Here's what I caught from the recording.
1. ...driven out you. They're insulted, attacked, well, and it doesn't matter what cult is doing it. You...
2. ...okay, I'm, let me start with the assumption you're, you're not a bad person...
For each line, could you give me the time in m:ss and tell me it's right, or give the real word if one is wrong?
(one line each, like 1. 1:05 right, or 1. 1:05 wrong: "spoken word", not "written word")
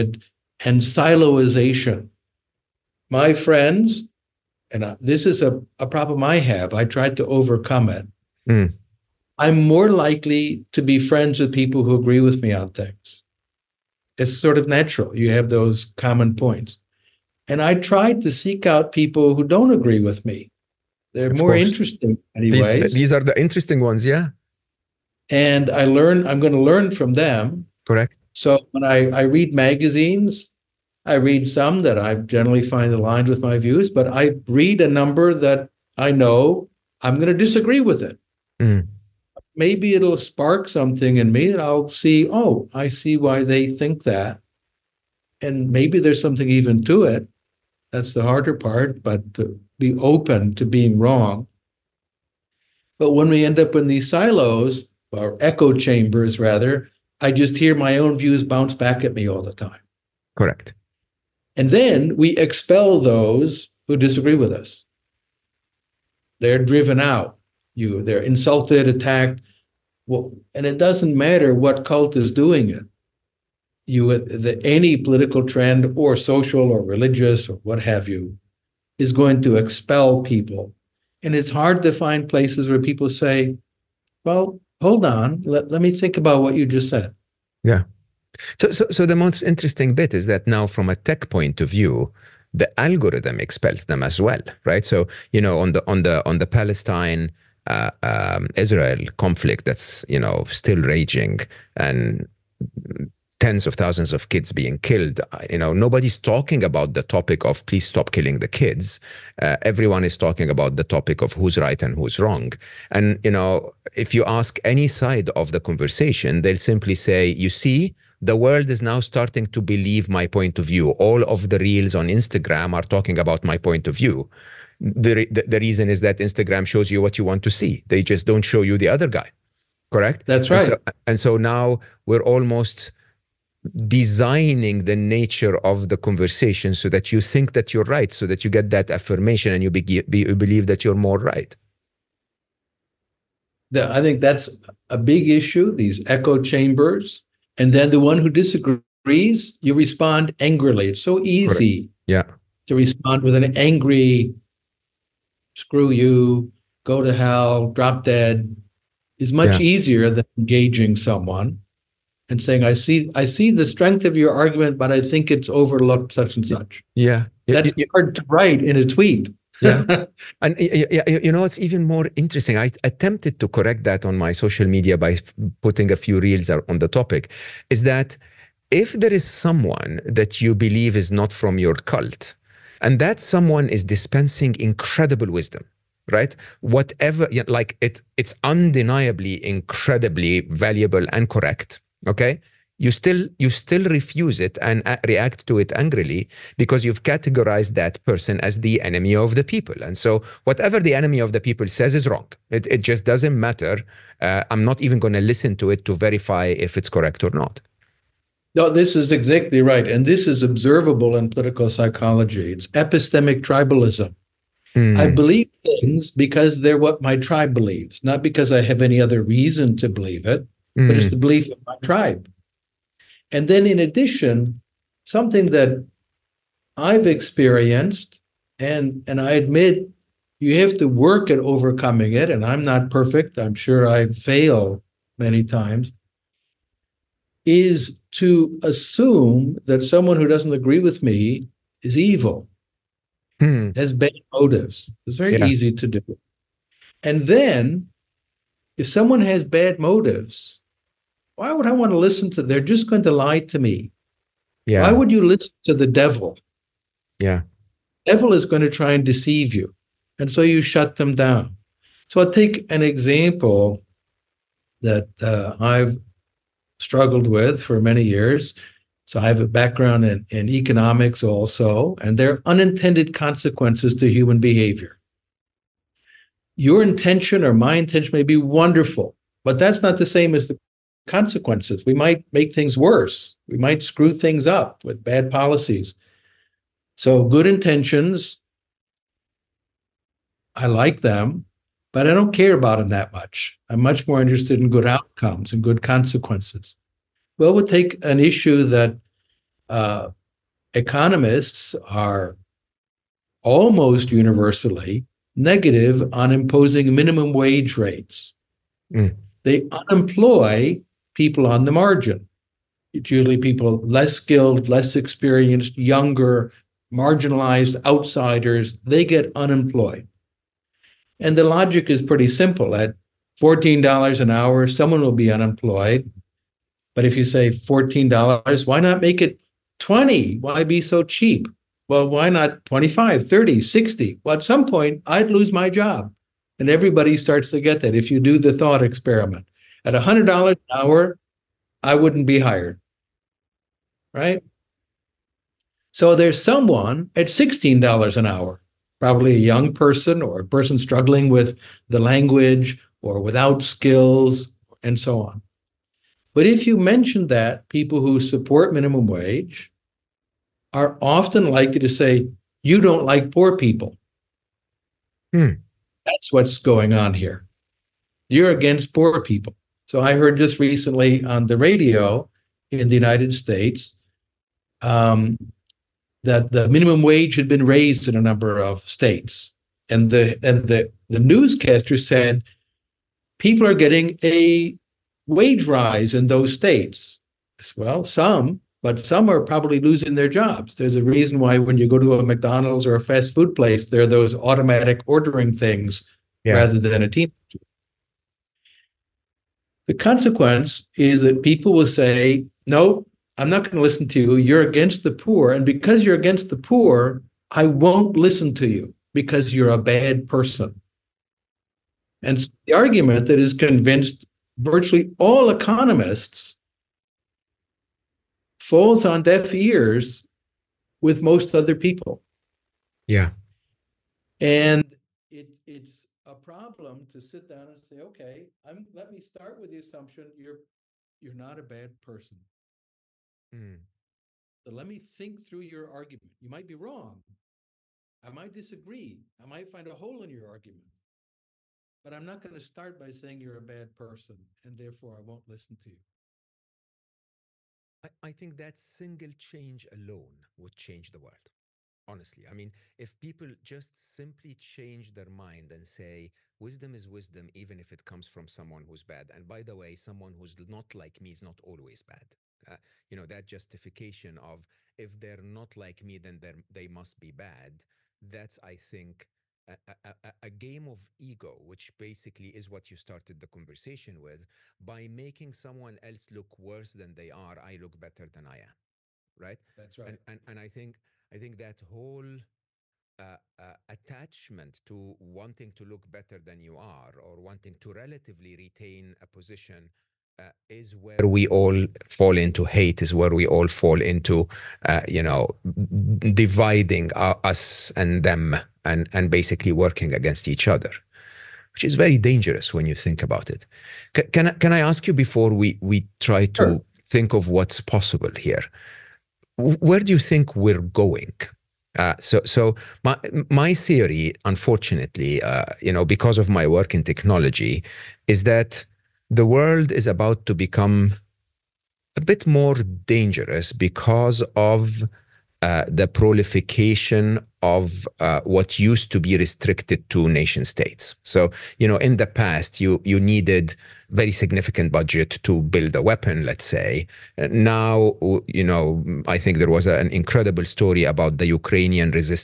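1. 1:06 right
2. 7:07 right.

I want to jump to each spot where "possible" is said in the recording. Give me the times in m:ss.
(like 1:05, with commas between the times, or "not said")
8:27.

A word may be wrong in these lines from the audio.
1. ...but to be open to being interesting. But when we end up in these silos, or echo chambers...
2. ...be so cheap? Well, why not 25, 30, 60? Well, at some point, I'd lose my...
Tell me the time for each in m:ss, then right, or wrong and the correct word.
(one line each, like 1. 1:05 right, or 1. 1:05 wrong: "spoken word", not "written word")
1. 0:49 wrong: "wrong", not "interesting"
2. 5:30 right.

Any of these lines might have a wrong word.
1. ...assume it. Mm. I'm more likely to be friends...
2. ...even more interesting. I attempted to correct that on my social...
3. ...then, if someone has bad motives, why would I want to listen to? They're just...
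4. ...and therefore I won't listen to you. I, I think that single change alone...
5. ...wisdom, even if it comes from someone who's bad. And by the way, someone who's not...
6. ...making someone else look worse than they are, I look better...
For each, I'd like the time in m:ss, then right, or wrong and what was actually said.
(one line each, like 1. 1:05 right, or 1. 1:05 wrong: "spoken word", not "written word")
1. 0:07 wrong: "overcome", not "assume"
2. 2:51 right
3. 4:07 right
4. 7:24 right
5. 7:37 right
6. 7:55 right.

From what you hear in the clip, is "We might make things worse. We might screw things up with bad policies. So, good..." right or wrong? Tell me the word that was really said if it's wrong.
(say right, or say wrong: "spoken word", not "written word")
right.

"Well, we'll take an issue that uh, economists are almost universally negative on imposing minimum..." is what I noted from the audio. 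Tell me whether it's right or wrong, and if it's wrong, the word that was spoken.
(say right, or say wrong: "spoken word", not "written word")
right.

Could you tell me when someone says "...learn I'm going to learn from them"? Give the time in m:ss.
0:25.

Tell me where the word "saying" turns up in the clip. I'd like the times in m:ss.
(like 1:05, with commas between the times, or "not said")
2:42, 7:23.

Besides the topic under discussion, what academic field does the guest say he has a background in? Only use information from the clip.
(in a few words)
economics.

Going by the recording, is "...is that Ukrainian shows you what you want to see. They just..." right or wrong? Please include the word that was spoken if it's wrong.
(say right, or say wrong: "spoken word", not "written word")
wrong: "Instagram", not "Ukrainian".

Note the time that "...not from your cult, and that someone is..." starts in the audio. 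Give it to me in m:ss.
3:01.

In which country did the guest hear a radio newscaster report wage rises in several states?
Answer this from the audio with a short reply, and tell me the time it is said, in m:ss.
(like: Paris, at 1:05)
United States, at 6:12.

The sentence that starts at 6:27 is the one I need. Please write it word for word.
Well, some, but some are probably losing their jobs.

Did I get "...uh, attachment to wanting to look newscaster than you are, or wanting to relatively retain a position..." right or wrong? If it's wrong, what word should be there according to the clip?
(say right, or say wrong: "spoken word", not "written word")
wrong: "better", not "newscaster".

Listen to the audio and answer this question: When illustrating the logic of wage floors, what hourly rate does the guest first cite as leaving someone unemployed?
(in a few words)
$14.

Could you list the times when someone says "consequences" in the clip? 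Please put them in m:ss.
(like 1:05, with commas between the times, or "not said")
4:33, 4:41, 4:55, 6:39.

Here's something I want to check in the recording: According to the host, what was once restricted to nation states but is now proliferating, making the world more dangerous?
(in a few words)
a weapon.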